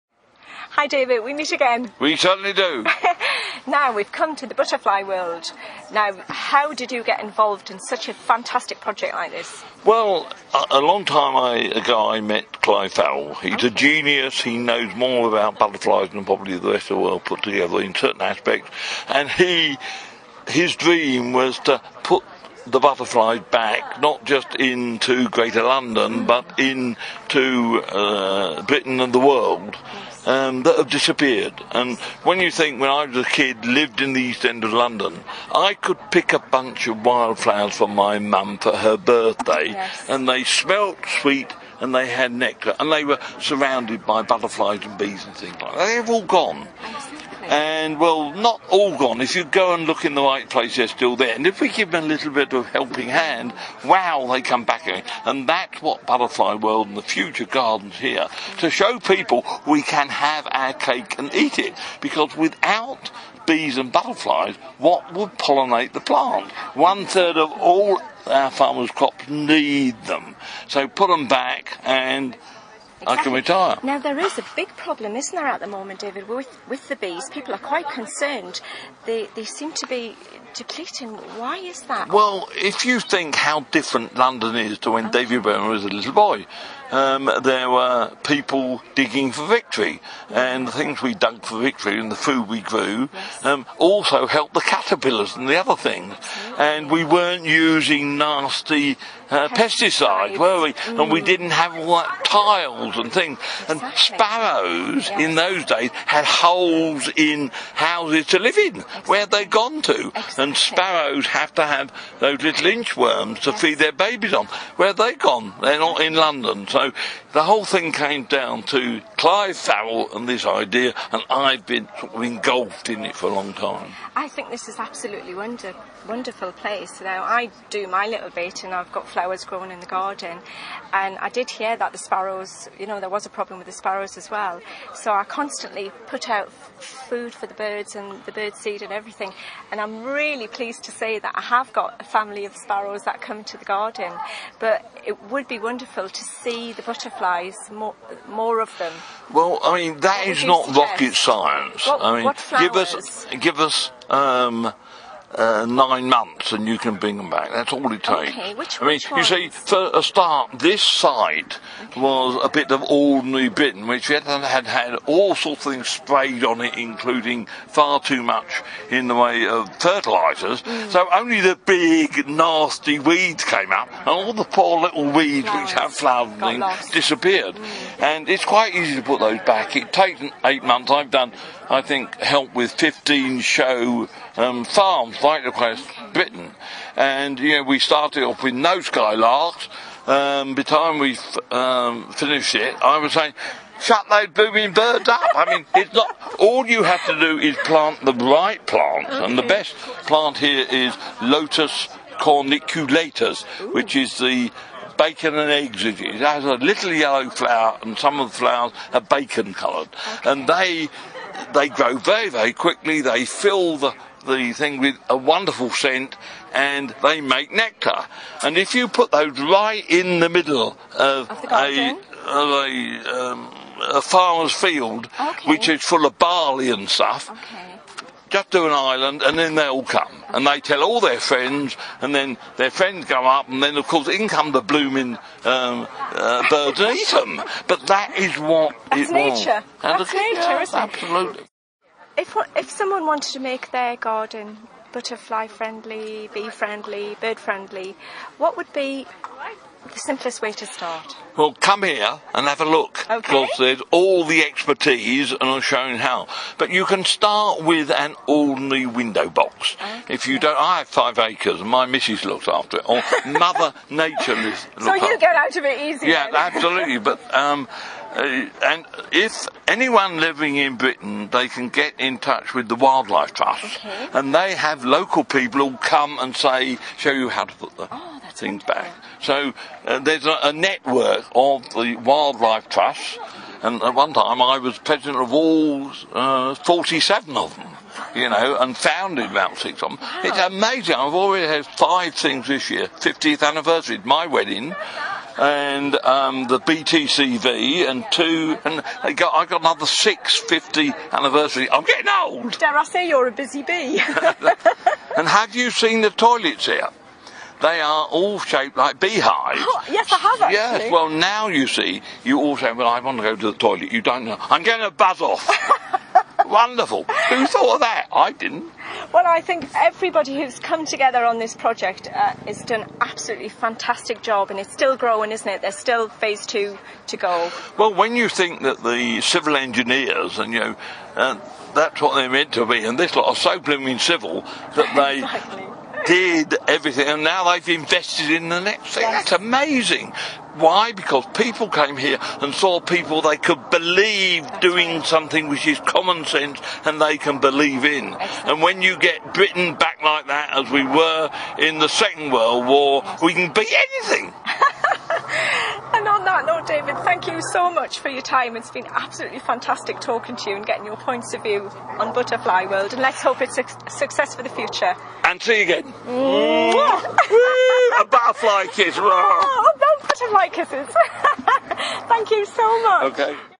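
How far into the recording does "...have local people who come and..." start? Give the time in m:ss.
4:34.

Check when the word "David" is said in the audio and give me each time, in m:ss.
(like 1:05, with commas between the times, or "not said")
0:00, 1:16, 1:25, 5:56.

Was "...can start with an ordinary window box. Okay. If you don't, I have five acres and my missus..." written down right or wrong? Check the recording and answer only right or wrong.
right.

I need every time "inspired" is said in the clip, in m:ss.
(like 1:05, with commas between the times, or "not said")
not said.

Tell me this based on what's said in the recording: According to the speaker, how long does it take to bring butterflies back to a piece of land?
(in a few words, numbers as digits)
9 months.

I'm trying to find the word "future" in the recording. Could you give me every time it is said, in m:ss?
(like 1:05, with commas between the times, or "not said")
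0:57, 6:04.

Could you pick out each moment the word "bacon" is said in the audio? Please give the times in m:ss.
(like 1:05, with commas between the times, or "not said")
3:24, 3:29.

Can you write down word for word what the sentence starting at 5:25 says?
There's still phase two to go.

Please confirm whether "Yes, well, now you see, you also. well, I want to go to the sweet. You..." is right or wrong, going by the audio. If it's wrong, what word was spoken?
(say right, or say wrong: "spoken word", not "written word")
wrong: "toilet", not "sweet".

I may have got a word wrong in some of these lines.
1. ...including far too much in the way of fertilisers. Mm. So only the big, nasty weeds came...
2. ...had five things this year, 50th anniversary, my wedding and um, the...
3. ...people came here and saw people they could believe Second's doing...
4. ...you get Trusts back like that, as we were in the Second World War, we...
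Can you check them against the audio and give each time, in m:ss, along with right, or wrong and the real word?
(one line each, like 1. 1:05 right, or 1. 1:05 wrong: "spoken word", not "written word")
1. 2:46 right
2. 4:51 right
3. 5:41 wrong: "That", not "Second"
4. 5:48 wrong: "Britain", not "Trusts".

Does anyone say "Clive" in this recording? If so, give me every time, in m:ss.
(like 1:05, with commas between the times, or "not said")
0:12, 1:59.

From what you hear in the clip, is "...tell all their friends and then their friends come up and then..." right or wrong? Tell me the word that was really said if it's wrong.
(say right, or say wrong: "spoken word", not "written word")
right.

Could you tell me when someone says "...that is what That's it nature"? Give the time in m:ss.
3:57.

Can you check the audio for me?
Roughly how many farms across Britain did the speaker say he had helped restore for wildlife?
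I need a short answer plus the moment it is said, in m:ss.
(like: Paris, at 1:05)
15, at 3:02.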